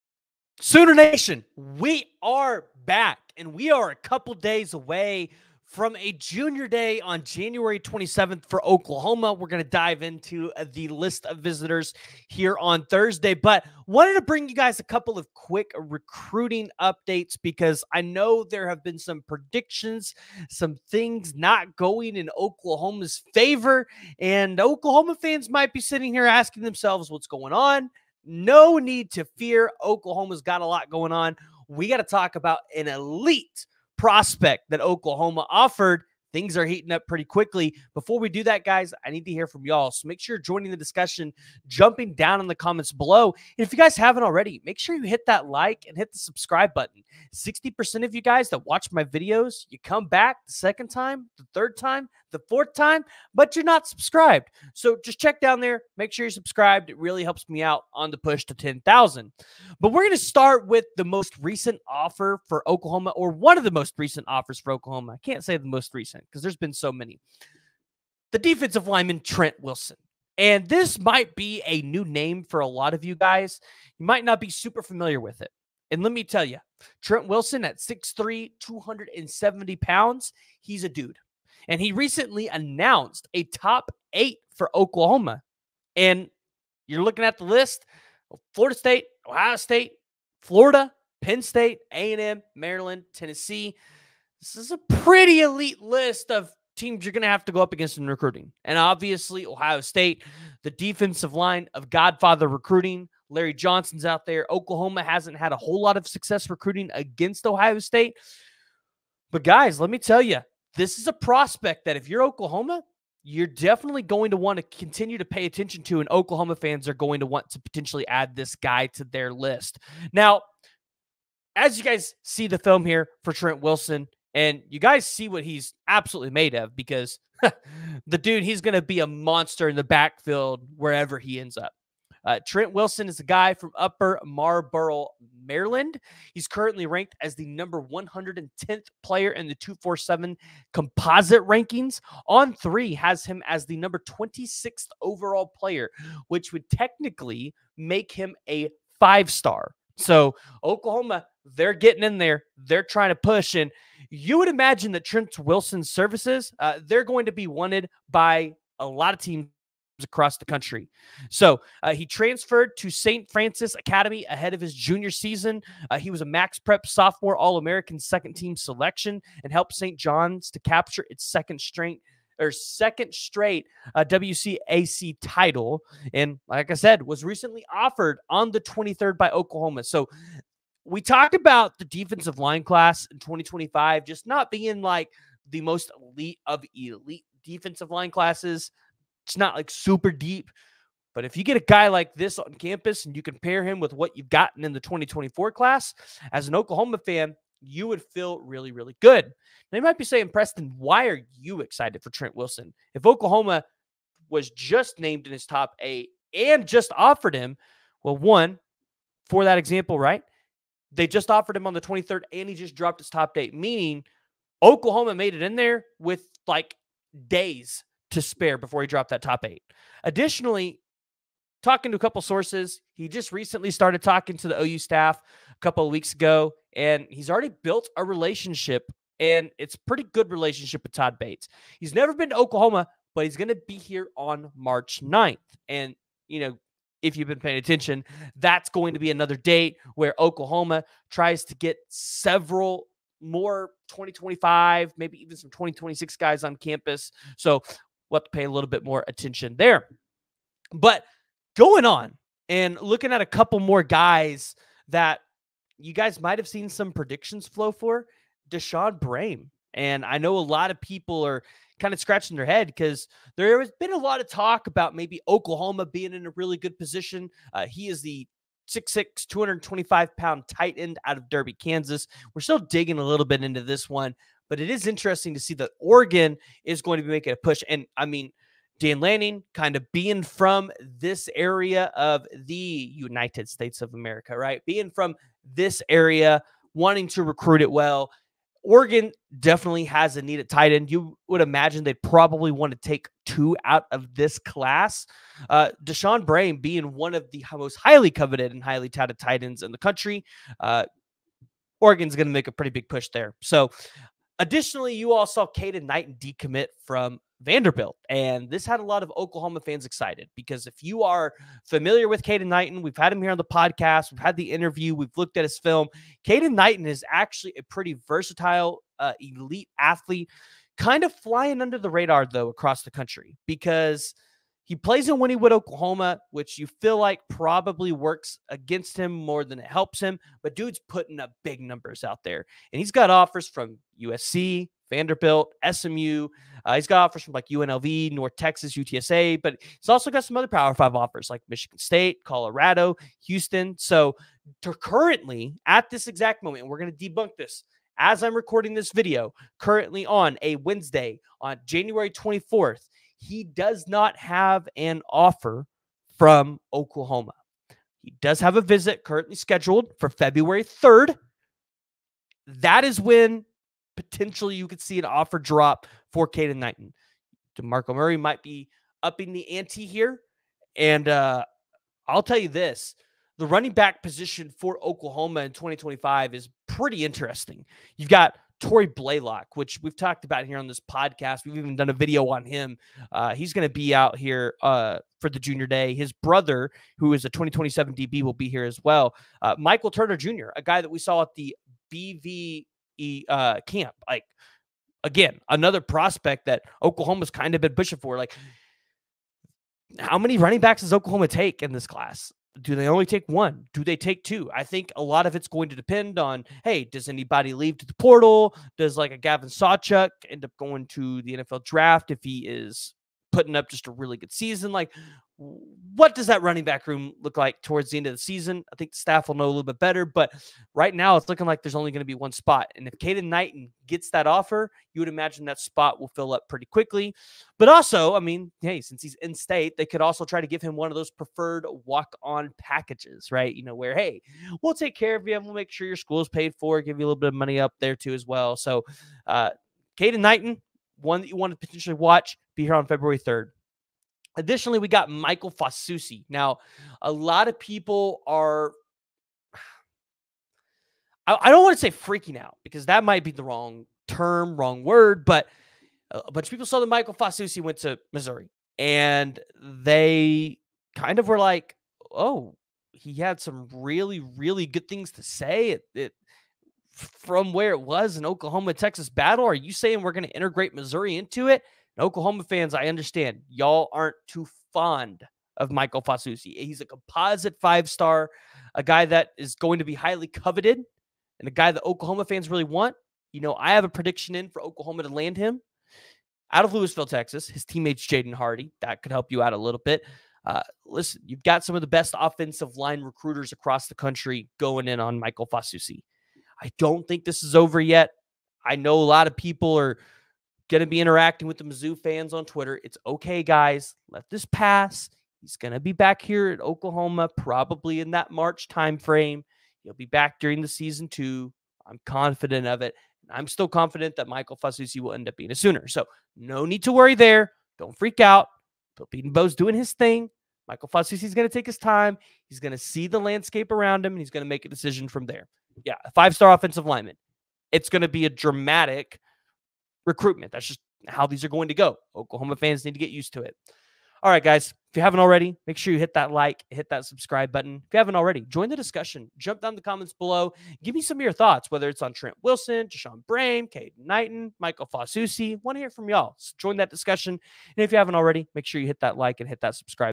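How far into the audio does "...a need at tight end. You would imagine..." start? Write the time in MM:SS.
04:50.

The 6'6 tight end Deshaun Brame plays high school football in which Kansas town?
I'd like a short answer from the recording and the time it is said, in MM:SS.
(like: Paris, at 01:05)
Derby, at 04:31.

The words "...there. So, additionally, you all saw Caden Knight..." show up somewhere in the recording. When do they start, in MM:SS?
05:03.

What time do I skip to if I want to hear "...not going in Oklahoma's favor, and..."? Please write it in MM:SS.
00:21.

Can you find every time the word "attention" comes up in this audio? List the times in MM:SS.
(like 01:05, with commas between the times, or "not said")
01:55, 03:57, 04:09.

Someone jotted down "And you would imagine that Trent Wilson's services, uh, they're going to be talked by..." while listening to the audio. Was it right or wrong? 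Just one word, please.
wrong.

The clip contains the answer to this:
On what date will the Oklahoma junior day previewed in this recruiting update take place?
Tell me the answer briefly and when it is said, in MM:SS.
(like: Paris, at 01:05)
January 27th, at 00:07.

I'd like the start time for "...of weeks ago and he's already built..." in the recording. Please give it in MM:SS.
03:45.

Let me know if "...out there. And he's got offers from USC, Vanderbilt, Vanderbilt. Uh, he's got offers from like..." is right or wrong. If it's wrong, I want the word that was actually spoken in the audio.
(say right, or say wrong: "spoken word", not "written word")
wrong: "SMU", not "Vanderbilt".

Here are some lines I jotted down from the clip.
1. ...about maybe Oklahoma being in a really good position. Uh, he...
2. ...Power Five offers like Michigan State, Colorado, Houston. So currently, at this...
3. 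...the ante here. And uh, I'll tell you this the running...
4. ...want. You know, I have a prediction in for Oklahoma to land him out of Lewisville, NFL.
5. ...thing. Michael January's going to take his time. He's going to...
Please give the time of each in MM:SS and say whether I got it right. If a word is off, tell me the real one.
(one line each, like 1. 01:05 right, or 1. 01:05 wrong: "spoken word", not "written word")
1. 04:24 right
2. 05:40 right
3. 06:09 right
4. 08:02 wrong: "Texas", not "NFL"
5. 08:39 wrong: "Fasusi", not "January".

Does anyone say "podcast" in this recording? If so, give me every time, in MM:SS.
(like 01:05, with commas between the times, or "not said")
05:13, 06:20.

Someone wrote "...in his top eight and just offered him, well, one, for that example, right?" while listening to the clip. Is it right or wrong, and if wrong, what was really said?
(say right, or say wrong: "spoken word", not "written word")
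right.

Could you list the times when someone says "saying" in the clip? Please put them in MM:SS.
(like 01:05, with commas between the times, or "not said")
03:20, 07:49.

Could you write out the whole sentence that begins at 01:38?
And obviously, Ohio State, the defensive line of Godfather recruiting.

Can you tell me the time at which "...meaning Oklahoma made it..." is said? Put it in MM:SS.
03:33.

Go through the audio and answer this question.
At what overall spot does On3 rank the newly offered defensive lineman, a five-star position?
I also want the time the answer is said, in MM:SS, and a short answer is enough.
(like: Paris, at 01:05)
26th, at 02:24.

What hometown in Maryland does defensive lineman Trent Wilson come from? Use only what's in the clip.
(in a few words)
Upper Marlboro.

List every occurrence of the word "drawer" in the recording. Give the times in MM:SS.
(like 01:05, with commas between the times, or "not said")
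not said.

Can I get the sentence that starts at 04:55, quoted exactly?
Uh, Deshaun Brame being one of the most highly coveted and highly touted tight ends in the country.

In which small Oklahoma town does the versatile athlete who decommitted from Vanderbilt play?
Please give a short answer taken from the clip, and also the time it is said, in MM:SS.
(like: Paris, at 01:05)
Wynnewood, at 05:25.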